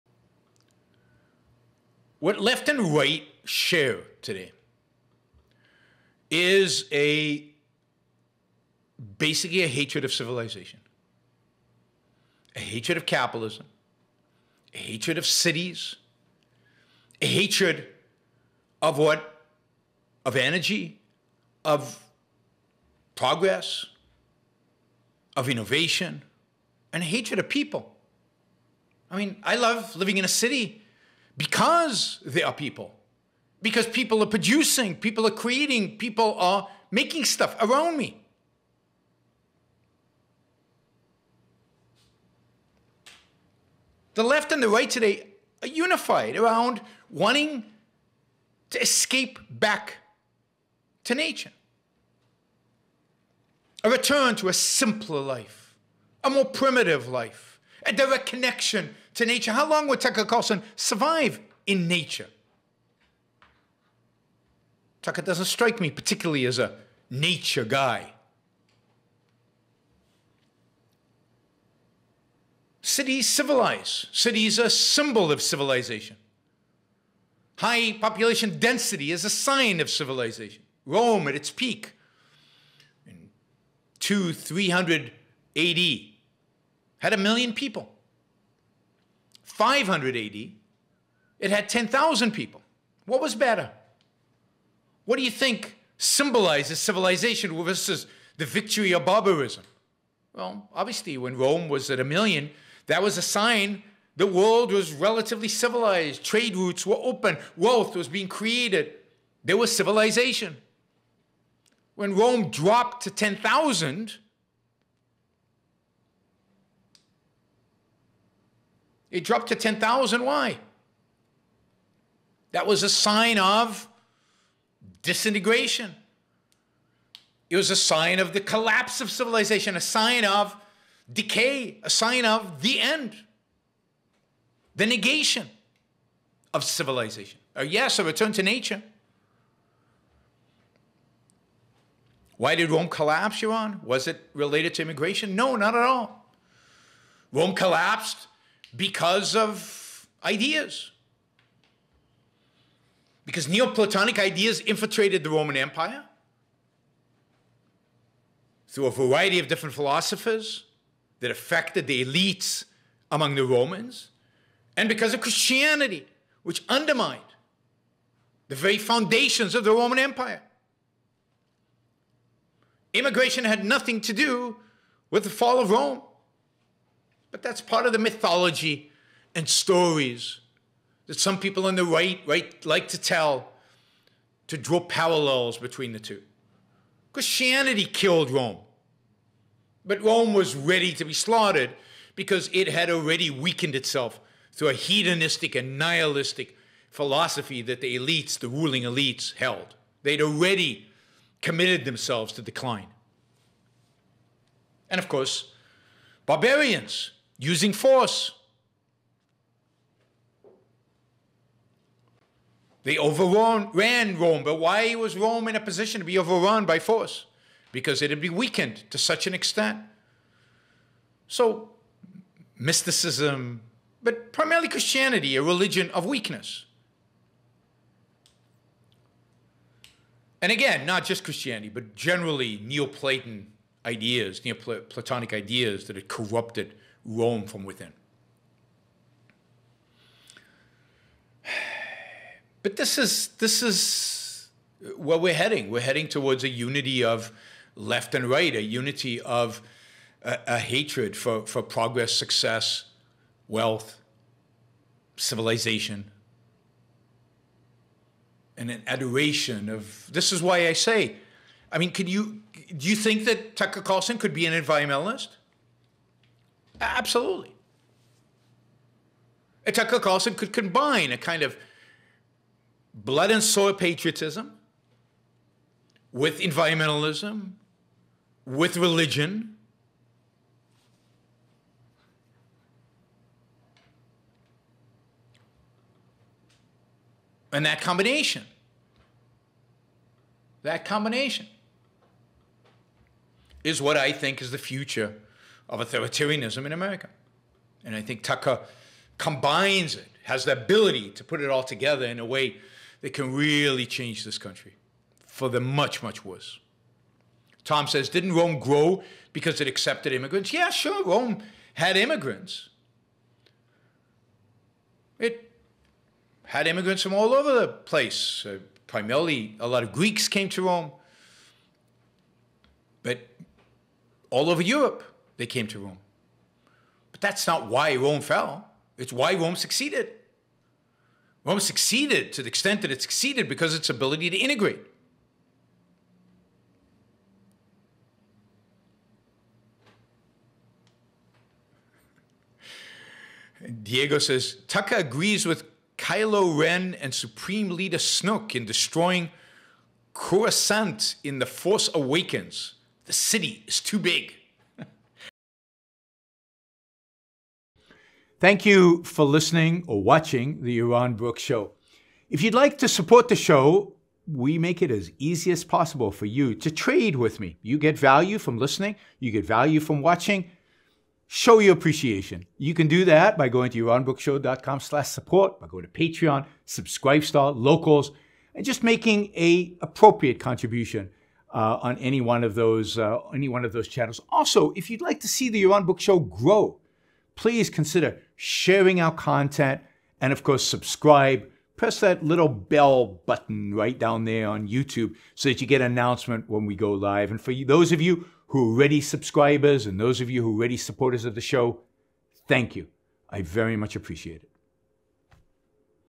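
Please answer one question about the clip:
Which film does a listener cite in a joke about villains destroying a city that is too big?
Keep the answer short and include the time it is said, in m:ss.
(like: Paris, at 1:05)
The Force Awakens, at 5:51.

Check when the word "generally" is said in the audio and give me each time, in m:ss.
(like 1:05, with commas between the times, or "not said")
3:51.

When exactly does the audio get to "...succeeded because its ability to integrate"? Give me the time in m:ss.
5:33.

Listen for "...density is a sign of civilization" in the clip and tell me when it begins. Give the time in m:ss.
1:18.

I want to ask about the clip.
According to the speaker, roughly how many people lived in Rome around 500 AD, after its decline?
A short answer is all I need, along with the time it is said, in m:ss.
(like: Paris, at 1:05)
10,000, at 1:31.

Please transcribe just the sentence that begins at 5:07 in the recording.
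Tom says, didn't Rome grow because it accepted immigrants?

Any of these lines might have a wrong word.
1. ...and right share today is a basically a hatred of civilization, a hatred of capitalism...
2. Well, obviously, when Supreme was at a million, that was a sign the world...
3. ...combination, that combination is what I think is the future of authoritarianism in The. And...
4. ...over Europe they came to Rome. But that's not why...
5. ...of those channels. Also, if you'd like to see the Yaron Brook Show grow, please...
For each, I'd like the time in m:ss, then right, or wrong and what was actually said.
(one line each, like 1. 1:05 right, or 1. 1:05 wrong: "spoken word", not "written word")
1. 0:02 right
2. 1:40 wrong: "Rome", not "Supreme"
3. 4:47 wrong: "America", not "The"
4. 5:24 right
5. 6:23 right.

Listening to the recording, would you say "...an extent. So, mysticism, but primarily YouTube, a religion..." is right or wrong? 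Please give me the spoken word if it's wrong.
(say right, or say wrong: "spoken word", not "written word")
wrong: "Christianity", not "YouTube".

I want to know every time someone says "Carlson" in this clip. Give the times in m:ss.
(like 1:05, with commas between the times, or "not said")
1:00, 4:23, 4:29.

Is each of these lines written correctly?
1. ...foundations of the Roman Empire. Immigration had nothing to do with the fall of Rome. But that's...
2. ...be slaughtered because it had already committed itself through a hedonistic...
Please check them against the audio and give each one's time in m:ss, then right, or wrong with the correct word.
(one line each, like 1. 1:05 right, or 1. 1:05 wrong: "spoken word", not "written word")
1. 2:48 right
2. 3:11 wrong: "weakened", not "committed".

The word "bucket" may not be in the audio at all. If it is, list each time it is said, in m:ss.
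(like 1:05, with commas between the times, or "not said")
not said.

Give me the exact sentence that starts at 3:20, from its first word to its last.
They'd already committed themselves to decline.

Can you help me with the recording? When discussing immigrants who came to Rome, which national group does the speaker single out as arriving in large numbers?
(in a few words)
Greeks.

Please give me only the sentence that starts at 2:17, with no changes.
Or uh, yes, a return to nature.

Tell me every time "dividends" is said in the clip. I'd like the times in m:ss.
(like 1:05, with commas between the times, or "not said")
not said.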